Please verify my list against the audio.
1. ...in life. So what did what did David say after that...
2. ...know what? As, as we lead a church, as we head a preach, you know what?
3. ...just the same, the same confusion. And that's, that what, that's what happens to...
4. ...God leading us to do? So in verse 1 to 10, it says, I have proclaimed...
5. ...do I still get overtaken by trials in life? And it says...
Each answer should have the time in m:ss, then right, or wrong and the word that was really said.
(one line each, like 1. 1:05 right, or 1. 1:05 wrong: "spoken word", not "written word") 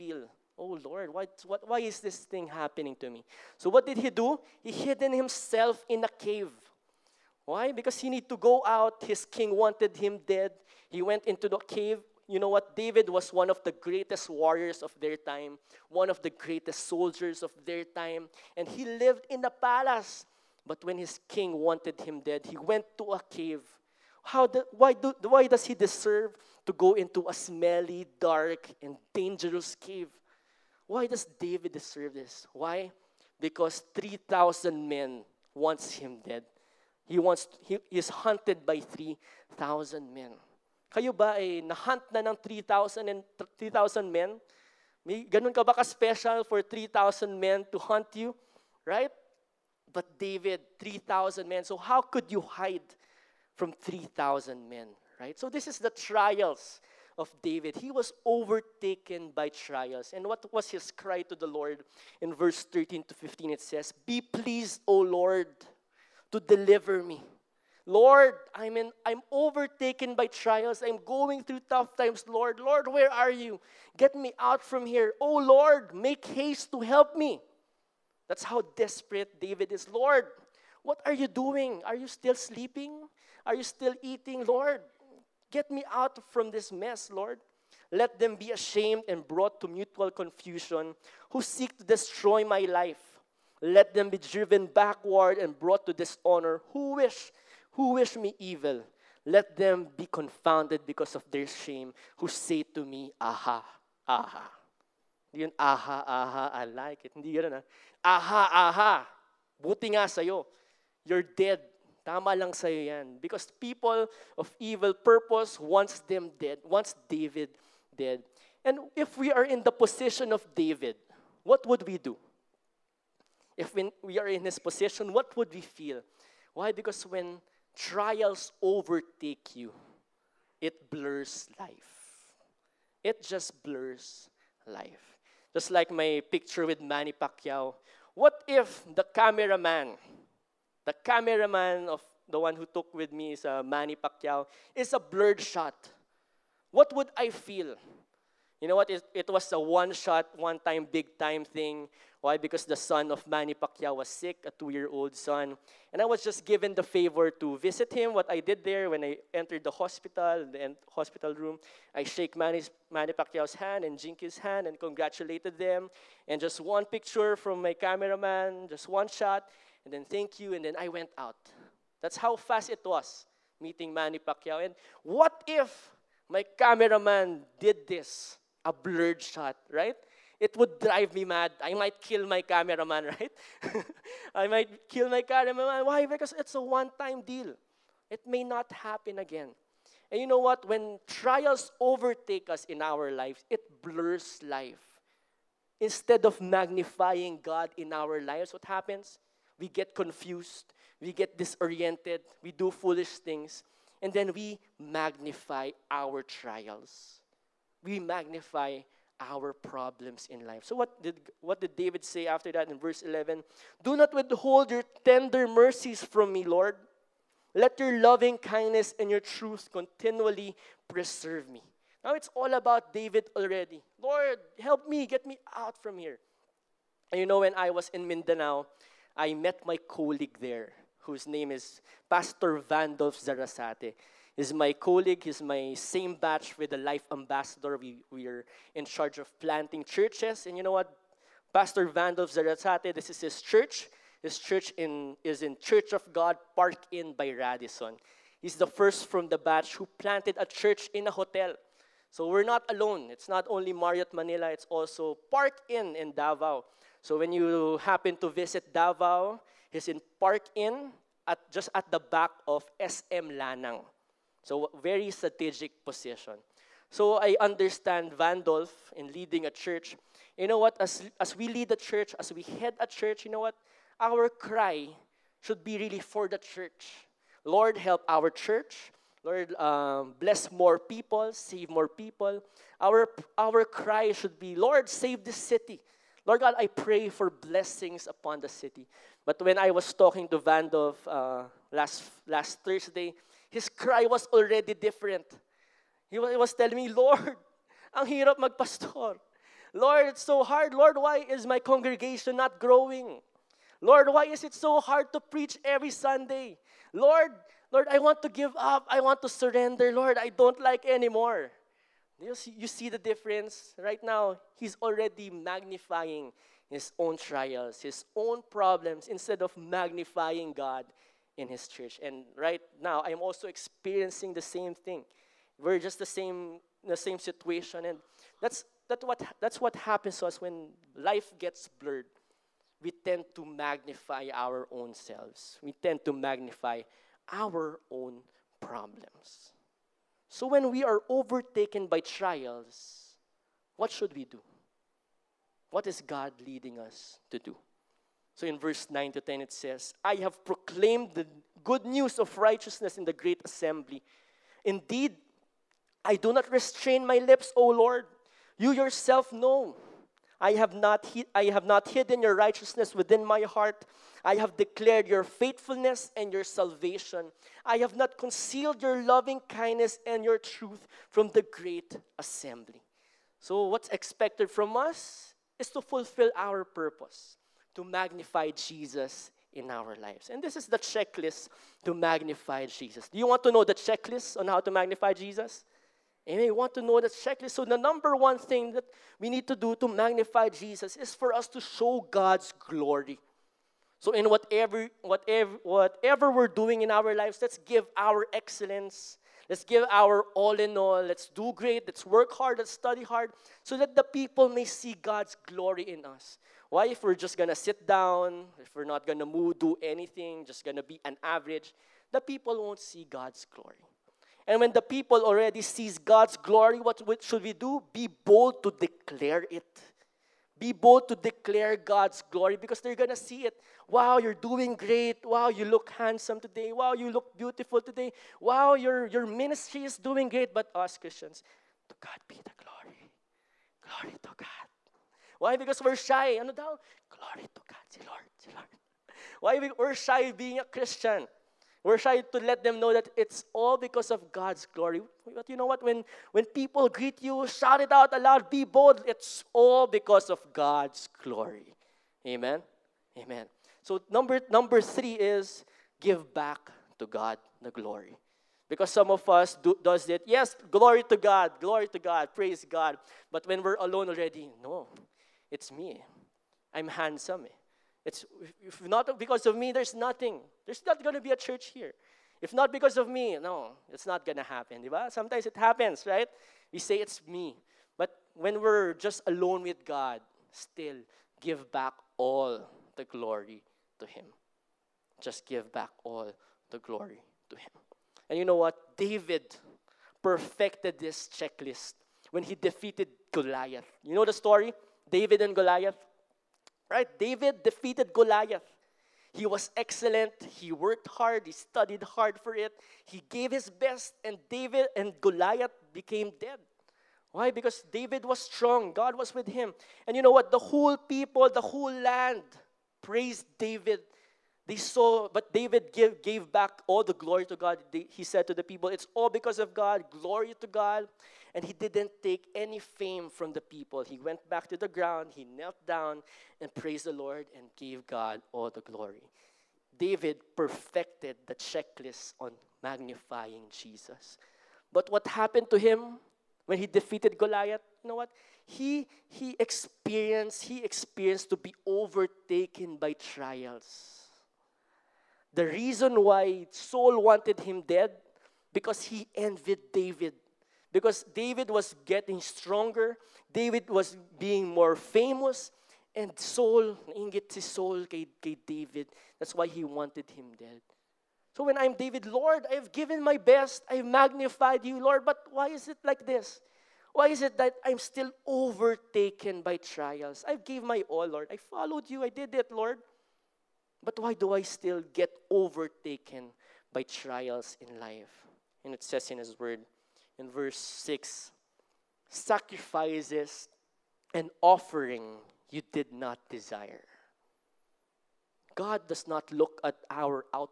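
1. 3:30 right
2. 4:30 wrong: "church", not "preach"
3. 5:25 wrong: "situation", not "confusion"
4. 5:46 wrong: "9", not "1"
5. 9:34 right.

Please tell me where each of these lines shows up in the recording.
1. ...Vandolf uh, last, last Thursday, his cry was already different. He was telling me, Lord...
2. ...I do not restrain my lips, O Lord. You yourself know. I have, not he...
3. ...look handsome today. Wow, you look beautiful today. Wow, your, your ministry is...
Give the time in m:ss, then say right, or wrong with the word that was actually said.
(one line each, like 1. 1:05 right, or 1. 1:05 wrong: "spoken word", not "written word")
1. 4:50 right
2. 5:56 right
3. 7:05 right.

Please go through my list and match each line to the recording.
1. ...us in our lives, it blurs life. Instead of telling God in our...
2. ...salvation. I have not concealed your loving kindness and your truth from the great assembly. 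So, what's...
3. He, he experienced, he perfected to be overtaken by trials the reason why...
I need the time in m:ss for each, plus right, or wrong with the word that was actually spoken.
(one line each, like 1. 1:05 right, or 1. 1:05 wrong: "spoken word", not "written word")
1. 3:12 wrong: "magnifying", not "telling"
2. 6:06 right
3. 8:58 wrong: "experienced", not "perfected".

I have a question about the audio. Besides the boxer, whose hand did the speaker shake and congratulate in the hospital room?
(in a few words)
Jinkee.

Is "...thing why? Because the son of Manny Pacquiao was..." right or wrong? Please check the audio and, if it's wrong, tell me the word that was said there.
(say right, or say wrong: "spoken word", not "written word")
right.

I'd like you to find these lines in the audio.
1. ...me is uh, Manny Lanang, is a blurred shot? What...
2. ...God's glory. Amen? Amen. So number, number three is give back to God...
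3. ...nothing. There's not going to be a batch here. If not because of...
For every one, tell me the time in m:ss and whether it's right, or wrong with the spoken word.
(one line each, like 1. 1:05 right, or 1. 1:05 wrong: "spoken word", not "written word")
1. 2:23 wrong: "Pacquiao", not "Lanang"
2. 7:30 right
3. 7:49 wrong: "church", not "batch".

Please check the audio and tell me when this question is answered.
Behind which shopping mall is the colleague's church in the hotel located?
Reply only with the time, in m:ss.
4:22.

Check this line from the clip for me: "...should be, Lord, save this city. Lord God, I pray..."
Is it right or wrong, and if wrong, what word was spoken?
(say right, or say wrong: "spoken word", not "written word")
right.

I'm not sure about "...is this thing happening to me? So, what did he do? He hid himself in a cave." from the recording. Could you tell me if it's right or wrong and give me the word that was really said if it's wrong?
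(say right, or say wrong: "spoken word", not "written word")
right.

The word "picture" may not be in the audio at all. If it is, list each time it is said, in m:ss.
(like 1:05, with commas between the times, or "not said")
2:16, 2:46.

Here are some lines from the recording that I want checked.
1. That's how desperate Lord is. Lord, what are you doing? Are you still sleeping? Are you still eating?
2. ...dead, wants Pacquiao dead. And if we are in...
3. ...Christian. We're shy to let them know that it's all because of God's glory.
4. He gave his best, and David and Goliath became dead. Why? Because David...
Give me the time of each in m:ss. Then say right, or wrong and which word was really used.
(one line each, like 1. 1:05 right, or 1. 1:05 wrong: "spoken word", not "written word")
1. 1:18 wrong: "David", not "Lord"
2. 1:56 wrong: "David", not "Pacquiao"
3. 7:20 right
4. 8:23 right.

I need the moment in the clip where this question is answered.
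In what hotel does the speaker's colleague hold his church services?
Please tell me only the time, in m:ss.
4:06.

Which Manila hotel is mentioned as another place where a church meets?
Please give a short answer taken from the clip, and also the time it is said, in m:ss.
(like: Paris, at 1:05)
Marriott Manila, at 4:13.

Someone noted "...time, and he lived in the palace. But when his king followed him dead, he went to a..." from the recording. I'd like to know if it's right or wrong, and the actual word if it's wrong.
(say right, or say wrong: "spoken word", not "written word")
wrong: "wanted", not "followed".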